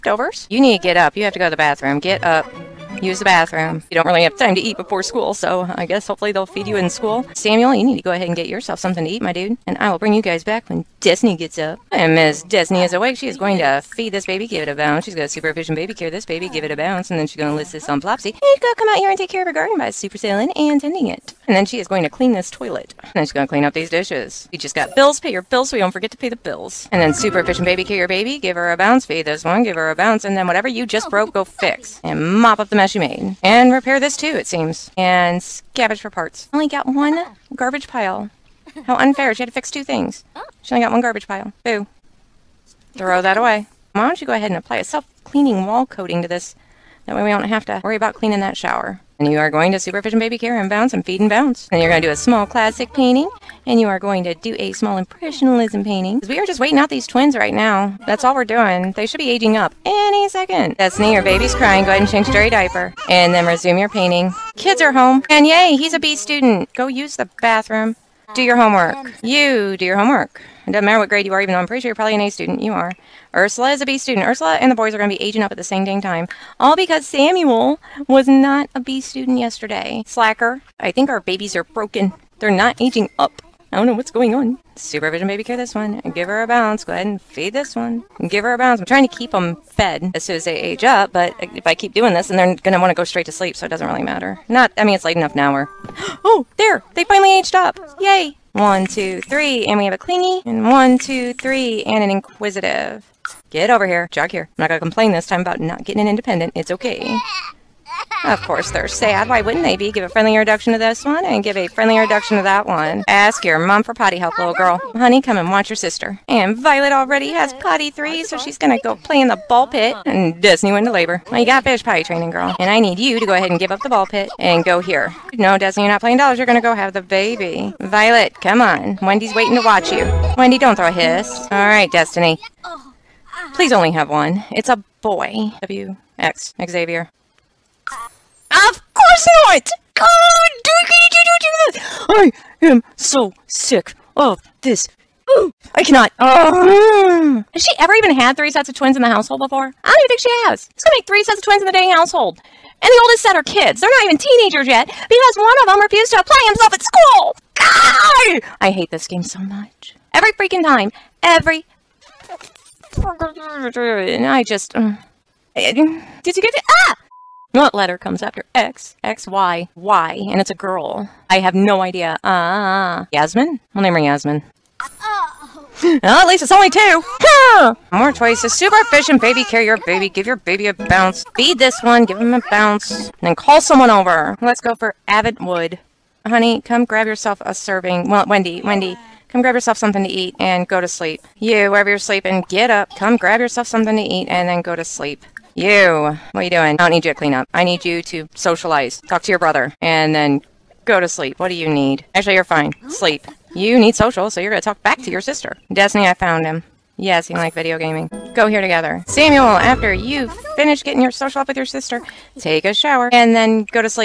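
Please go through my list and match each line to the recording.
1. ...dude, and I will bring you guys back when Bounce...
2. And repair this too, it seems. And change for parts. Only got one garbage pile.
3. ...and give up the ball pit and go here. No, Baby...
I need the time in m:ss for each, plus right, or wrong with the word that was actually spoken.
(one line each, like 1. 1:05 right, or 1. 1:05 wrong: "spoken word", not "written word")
1. 0:09 wrong: "Disney", not "Bounce"
2. 0:33 wrong: "scavenge", not "change"
3. 2:03 wrong: "Destiny", not "Baby".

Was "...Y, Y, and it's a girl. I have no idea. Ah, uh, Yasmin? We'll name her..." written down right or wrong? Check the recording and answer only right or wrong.
right.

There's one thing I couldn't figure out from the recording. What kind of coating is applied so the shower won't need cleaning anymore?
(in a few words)
self-cleaning wall coating.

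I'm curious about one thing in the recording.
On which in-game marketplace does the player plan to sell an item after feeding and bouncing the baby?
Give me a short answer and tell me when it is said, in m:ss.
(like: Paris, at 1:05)
Plopsy, at 0:17.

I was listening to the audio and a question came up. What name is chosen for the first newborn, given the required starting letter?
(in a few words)
Xavier.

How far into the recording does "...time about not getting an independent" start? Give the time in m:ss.
1:45.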